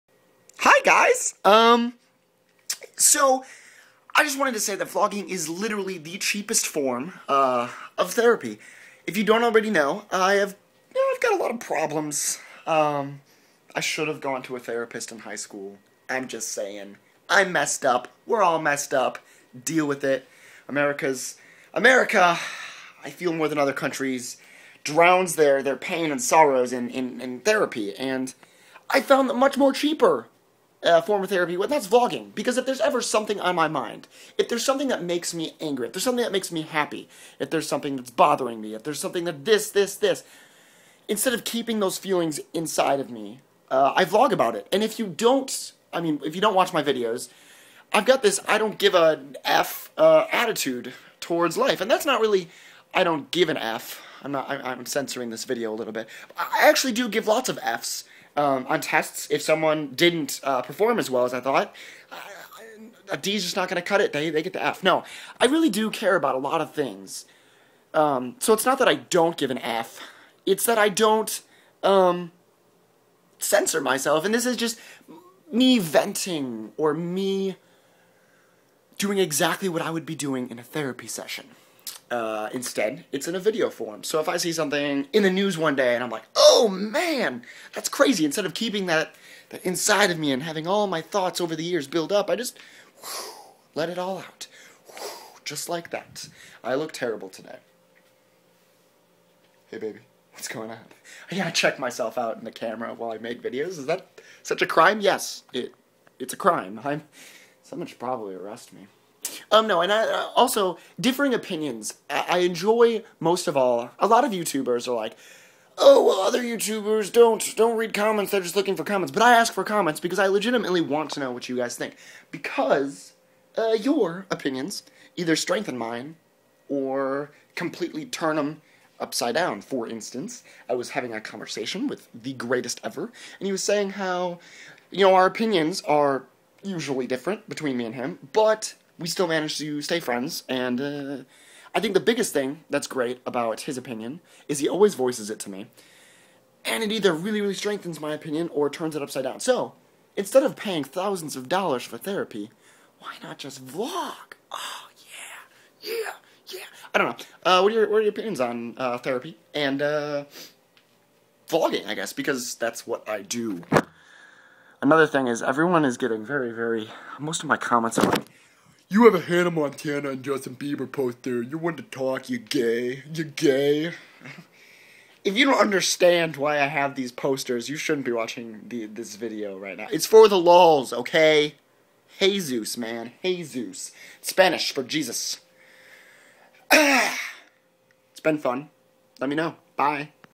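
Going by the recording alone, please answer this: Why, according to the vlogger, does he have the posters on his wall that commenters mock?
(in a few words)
for the lols.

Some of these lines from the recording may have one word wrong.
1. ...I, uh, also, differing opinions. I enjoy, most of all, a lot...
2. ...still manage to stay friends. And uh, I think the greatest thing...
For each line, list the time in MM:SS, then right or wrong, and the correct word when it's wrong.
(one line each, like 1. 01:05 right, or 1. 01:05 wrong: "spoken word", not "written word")
1. 01:49 right
2. 02:19 wrong: "biggest", not "greatest".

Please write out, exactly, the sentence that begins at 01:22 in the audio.
Uh, instead, it's in a video form.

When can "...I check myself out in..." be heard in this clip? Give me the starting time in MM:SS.
01:41.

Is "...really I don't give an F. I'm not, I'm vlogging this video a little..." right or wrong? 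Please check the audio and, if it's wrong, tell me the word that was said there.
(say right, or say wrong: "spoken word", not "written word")
wrong: "censoring", not "vlogging".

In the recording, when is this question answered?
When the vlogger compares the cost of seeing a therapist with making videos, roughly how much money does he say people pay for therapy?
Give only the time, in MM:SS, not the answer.
02:30.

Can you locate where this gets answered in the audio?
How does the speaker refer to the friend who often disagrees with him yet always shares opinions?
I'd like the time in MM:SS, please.
02:12.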